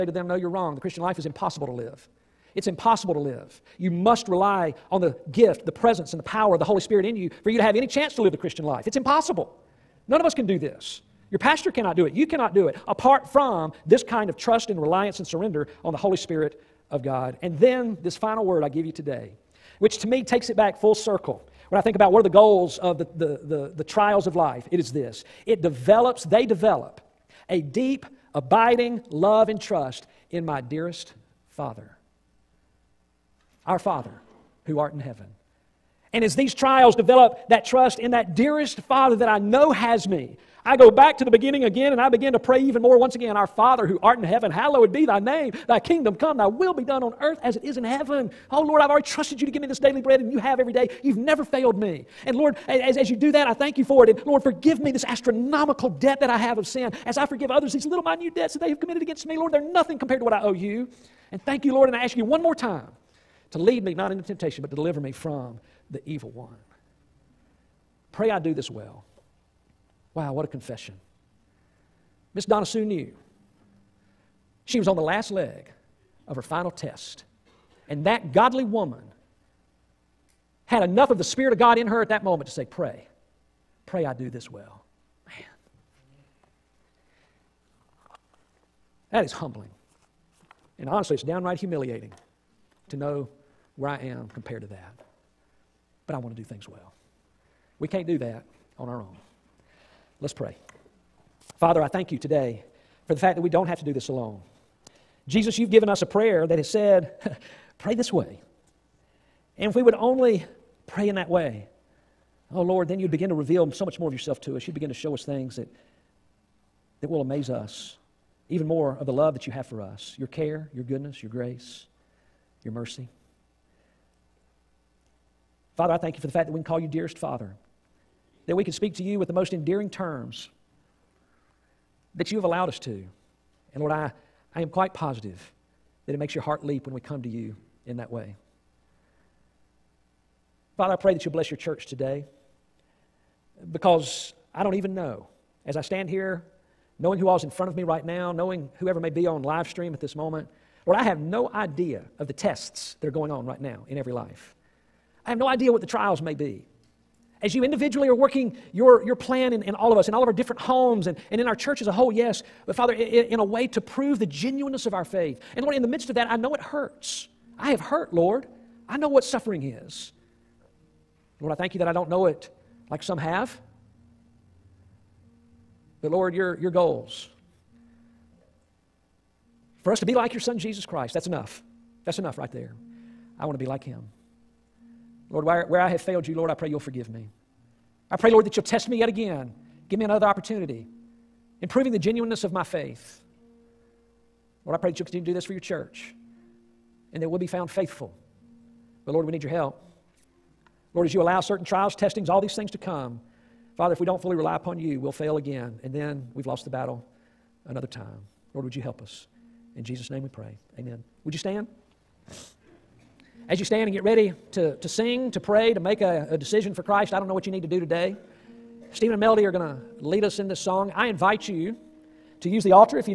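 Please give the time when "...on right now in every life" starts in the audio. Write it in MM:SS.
02:33.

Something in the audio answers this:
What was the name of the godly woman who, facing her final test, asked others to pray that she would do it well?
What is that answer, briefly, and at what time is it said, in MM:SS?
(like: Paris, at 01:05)
Donna Sue, at 01:12.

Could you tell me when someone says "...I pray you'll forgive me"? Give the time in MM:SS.
03:06.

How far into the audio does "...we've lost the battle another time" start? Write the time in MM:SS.
03:26.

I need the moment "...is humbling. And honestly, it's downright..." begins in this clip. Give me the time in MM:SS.
01:29.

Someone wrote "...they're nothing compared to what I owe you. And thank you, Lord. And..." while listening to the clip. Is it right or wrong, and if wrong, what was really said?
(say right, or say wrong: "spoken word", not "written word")
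right.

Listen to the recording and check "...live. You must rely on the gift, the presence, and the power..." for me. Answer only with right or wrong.
right.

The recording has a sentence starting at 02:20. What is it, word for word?
Father, I pray that you'll bless your church today because I don't even know.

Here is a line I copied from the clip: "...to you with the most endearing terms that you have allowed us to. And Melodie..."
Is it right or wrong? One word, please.
wrong.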